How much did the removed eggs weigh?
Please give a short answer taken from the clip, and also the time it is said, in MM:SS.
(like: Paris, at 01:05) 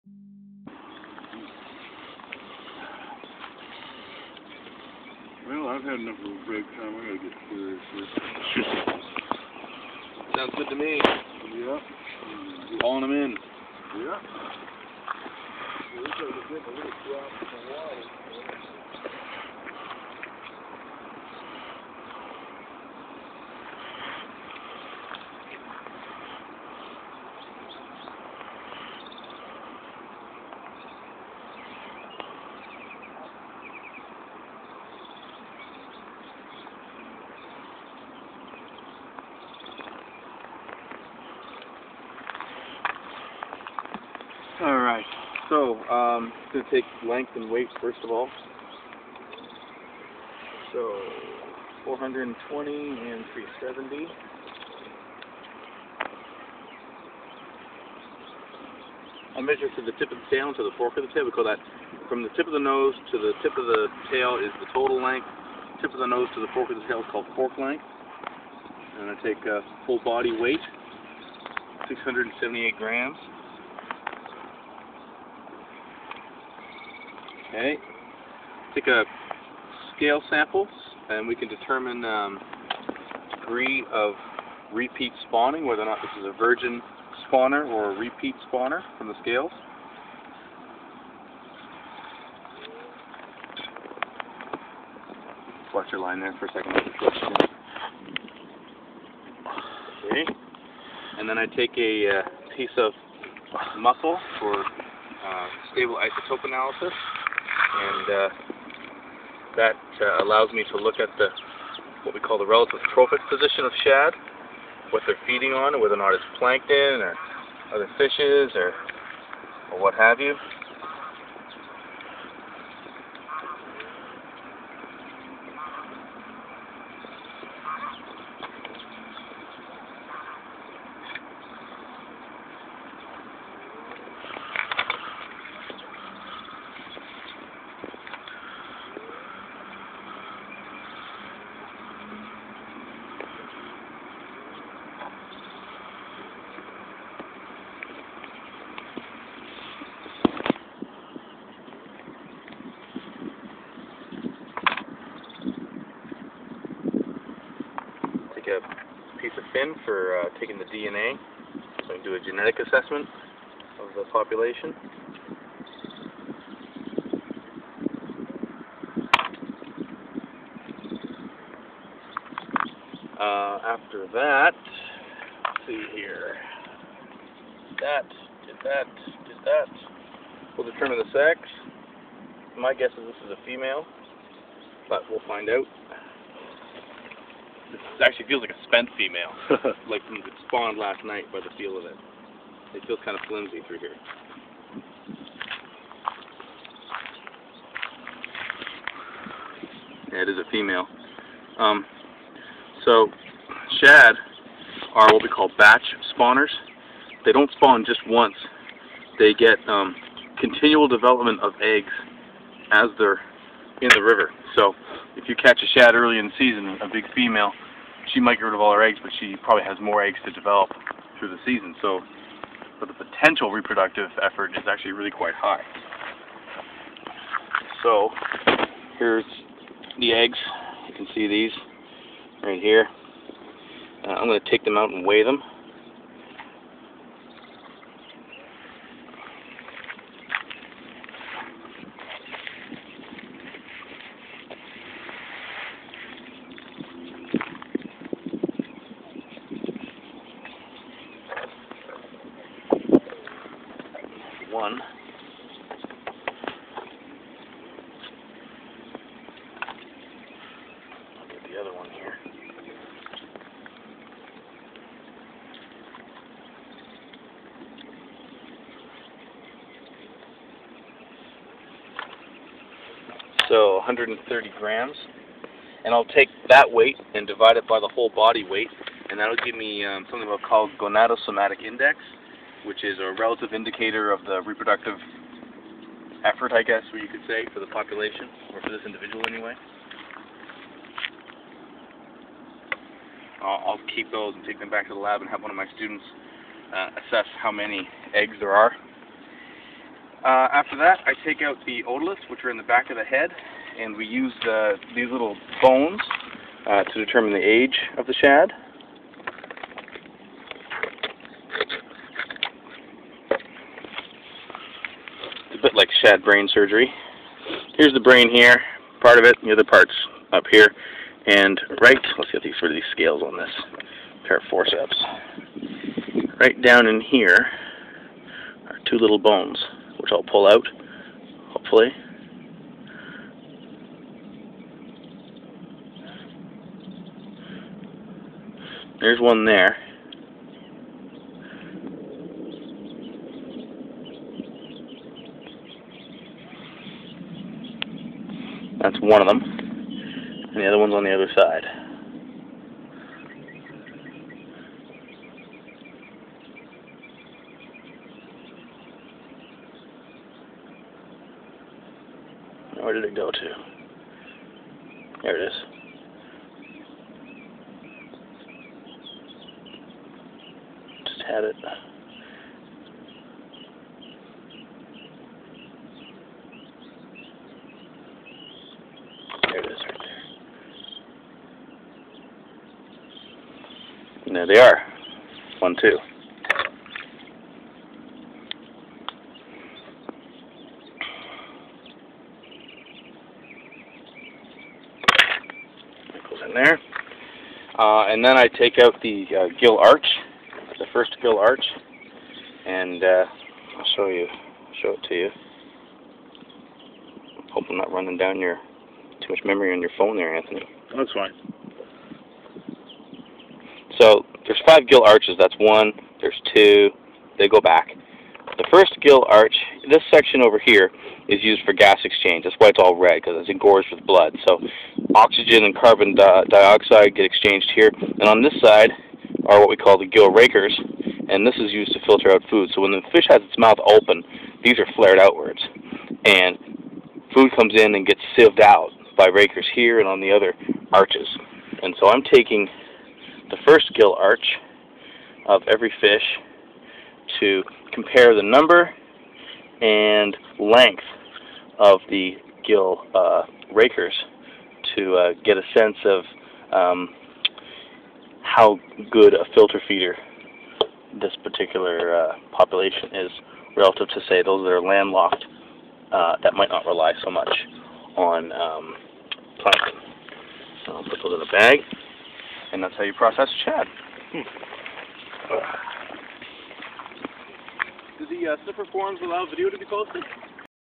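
130 grams, at 04:33.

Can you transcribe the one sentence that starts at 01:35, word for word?
Watch your line there for a second.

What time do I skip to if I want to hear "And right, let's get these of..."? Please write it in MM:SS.
05:21.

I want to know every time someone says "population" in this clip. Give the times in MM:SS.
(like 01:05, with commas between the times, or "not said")
02:44, 04:47, 07:42.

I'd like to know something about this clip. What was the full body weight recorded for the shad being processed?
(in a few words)
678 grams.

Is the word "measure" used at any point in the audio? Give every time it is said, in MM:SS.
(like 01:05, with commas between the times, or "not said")
00:59.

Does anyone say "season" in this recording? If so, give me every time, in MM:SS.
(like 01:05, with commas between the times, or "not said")
03:36, 03:41.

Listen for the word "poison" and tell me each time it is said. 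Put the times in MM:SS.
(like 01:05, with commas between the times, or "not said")
not said.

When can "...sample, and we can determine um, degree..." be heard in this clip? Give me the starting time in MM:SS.
01:20.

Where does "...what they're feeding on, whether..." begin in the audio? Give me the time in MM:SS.
01:54.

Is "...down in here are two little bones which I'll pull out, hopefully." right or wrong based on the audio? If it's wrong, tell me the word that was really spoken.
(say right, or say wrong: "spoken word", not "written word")
right.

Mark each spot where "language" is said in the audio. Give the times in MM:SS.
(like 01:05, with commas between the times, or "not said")
not said.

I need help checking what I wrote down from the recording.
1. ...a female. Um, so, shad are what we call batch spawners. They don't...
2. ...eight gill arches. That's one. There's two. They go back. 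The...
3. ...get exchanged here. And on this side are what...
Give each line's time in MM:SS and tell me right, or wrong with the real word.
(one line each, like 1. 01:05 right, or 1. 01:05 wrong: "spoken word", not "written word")
1. 03:20 right
2. 06:54 wrong: "five", not "eight"
3. 07:07 right.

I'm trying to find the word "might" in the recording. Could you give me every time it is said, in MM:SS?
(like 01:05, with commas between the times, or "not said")
03:38, 07:46.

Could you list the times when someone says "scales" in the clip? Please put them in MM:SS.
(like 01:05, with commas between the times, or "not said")
01:19, 01:29, 05:22.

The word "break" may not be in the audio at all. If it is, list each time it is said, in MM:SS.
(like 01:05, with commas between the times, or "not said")
00:06.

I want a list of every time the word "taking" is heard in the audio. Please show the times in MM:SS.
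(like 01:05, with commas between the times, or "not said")
02:40, 07:22.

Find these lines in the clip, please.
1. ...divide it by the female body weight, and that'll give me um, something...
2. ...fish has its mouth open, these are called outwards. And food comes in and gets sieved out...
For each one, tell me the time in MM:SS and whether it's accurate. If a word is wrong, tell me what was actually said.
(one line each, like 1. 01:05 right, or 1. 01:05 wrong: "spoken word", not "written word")
1. 04:37 wrong: "whole", not "female"
2. 07:13 wrong: "flared", not "called".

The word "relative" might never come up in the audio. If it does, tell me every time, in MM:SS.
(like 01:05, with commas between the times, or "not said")
01:52, 04:43, 07:43.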